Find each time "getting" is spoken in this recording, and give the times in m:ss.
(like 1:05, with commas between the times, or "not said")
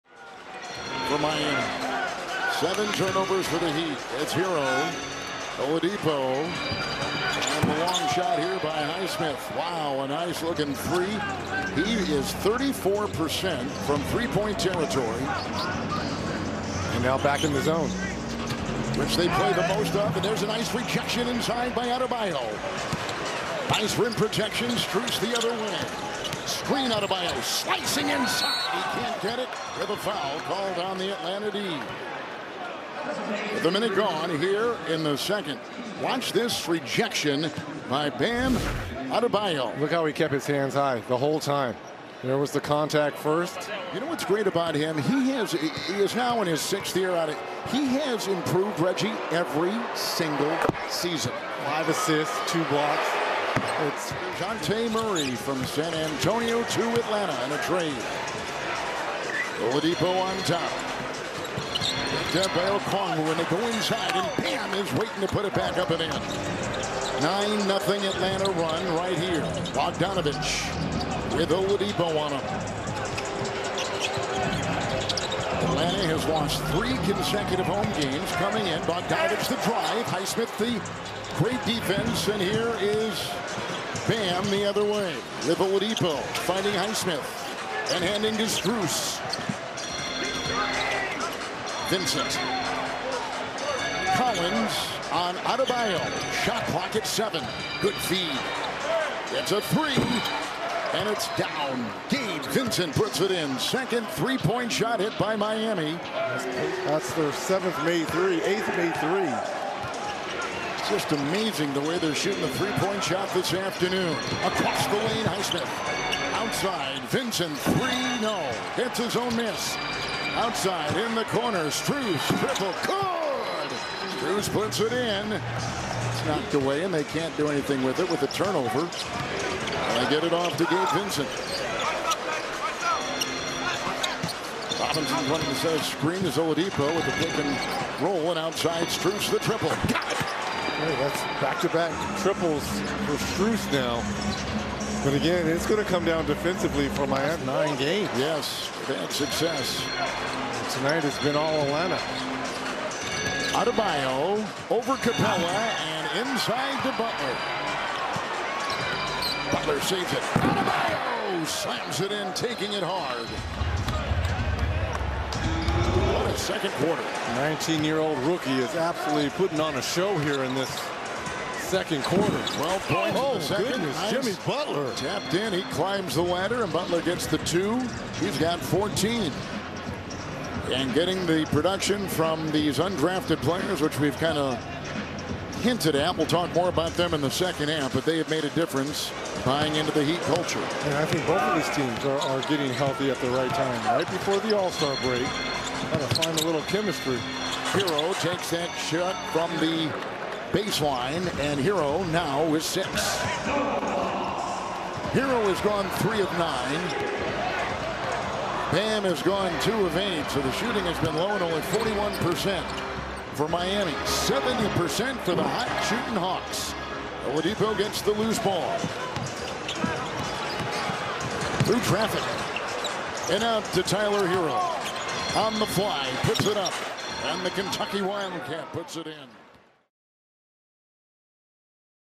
3:00, 3:12.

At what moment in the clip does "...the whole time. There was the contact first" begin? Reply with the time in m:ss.
0:41.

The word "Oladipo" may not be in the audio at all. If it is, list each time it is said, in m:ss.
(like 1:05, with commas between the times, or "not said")
0:05, 0:59, 1:11, 1:25, 2:16, 3:37.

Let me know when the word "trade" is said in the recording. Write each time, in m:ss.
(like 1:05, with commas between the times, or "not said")
0:57.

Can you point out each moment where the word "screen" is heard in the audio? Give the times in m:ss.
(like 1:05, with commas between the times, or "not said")
0:26, 2:15.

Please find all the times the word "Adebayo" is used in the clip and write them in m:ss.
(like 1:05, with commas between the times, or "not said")
0:21, 0:26, 0:39, 1:35, 2:33, 2:40.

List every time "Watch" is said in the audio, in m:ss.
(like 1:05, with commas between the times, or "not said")
0:36.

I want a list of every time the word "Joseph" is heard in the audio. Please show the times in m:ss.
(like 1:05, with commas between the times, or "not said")
not said.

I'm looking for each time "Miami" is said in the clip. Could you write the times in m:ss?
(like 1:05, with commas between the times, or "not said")
0:01, 1:45, 2:27, 3:33.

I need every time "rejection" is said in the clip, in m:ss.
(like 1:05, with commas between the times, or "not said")
0:20, 0:36.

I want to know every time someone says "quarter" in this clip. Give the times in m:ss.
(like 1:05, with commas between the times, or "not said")
2:46, 2:52.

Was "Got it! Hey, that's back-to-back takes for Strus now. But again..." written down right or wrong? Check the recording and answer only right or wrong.
wrong.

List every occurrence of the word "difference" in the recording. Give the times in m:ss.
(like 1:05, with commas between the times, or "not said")
3:08.